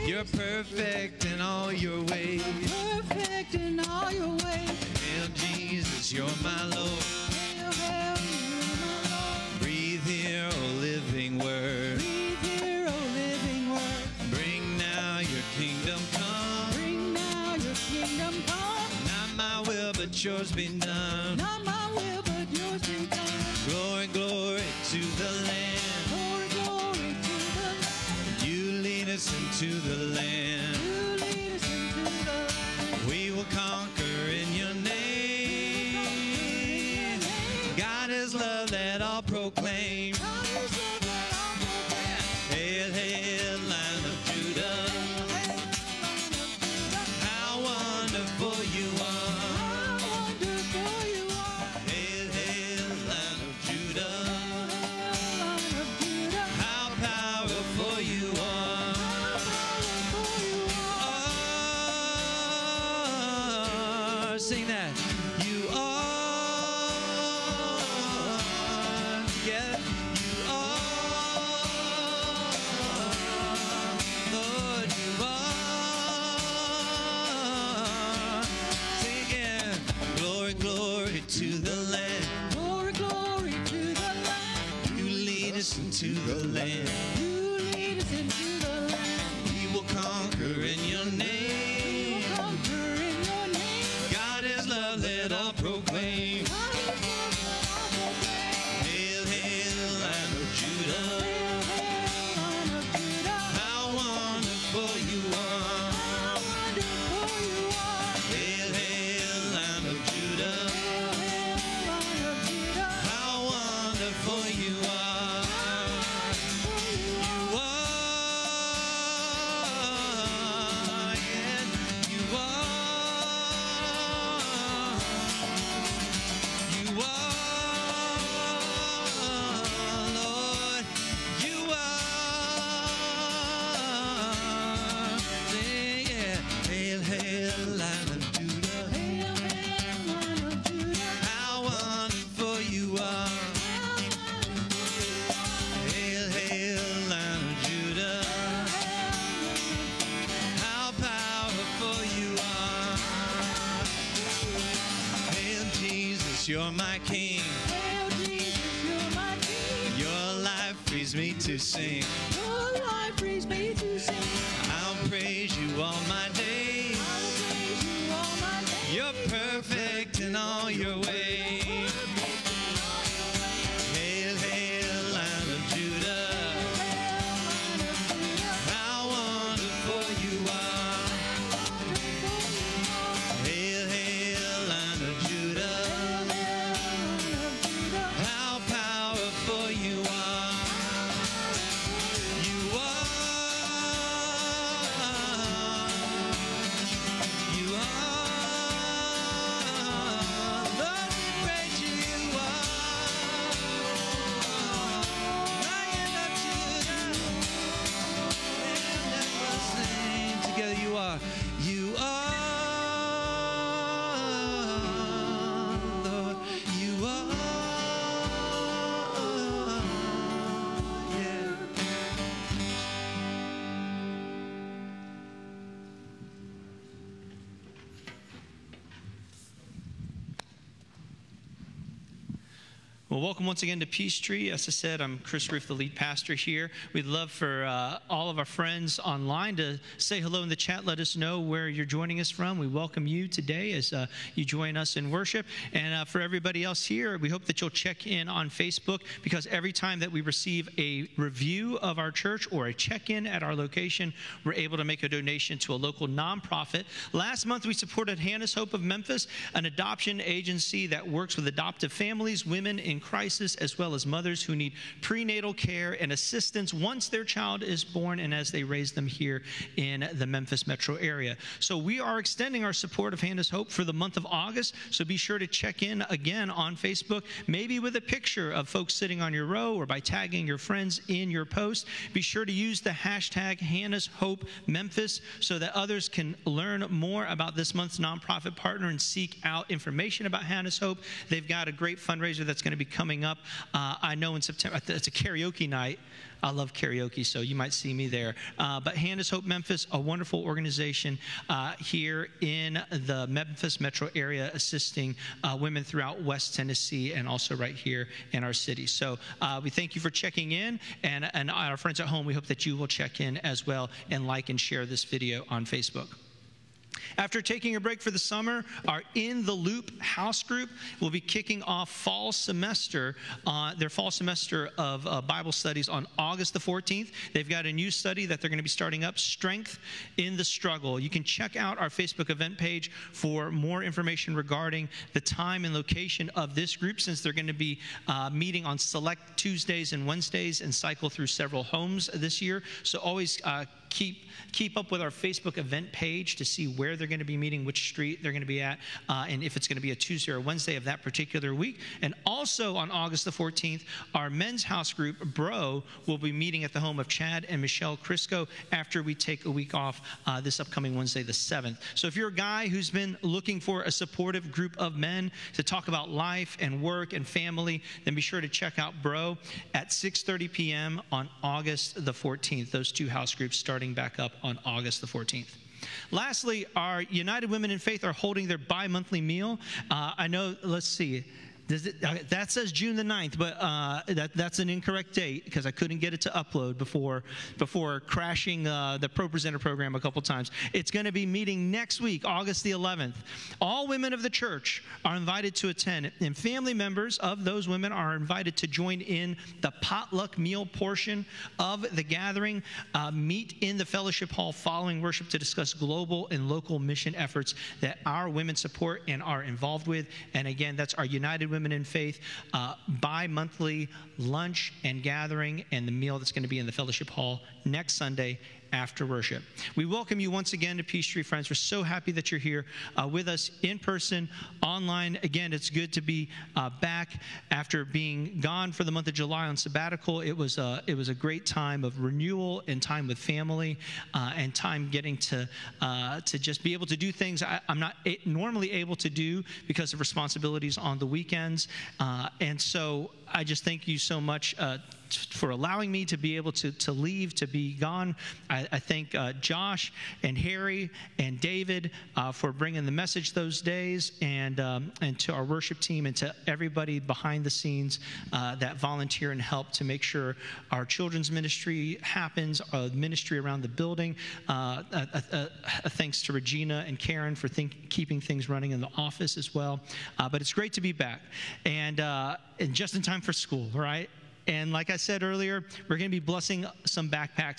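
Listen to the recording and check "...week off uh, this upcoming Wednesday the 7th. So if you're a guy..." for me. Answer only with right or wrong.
right.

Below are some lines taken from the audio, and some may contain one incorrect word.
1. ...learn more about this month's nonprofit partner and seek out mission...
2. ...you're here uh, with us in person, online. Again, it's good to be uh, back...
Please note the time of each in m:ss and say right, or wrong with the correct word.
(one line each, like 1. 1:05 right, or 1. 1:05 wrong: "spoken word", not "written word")
1. 4:46 wrong: "information", not "mission"
2. 7:02 right.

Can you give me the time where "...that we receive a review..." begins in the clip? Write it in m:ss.
4:10.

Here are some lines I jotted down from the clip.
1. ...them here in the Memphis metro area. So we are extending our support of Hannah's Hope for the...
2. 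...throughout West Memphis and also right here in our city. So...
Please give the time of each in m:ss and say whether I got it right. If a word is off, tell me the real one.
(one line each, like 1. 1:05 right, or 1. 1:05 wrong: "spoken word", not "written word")
1. 4:28 right
2. 5:05 wrong: "Tennessee", not "Memphis".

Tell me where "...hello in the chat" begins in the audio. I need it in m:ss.
4:00.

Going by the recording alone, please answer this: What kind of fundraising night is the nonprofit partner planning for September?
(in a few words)
Karaoke night.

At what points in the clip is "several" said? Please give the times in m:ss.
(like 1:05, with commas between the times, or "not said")
5:41.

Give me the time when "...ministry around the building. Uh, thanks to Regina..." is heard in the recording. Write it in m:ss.
7:42.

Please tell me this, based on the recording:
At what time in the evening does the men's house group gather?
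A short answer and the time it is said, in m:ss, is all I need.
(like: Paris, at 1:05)
6:30 p.m., at 6:09.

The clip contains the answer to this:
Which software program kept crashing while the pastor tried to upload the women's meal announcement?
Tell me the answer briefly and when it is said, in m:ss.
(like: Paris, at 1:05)
Pro Presenter, at 6:29.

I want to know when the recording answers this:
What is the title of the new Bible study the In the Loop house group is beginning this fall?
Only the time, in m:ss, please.
5:29.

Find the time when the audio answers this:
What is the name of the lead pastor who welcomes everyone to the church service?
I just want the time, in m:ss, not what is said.
3:55.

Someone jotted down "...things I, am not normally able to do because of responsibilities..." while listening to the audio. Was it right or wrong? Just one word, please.
right.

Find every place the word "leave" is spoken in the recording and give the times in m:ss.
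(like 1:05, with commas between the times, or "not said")
7:26.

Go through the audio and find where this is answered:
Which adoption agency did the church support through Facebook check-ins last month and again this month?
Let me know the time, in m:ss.
4:18.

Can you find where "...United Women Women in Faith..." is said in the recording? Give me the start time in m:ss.
6:51.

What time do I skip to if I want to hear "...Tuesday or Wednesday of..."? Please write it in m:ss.
5:49.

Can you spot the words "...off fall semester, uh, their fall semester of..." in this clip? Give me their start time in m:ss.
5:21.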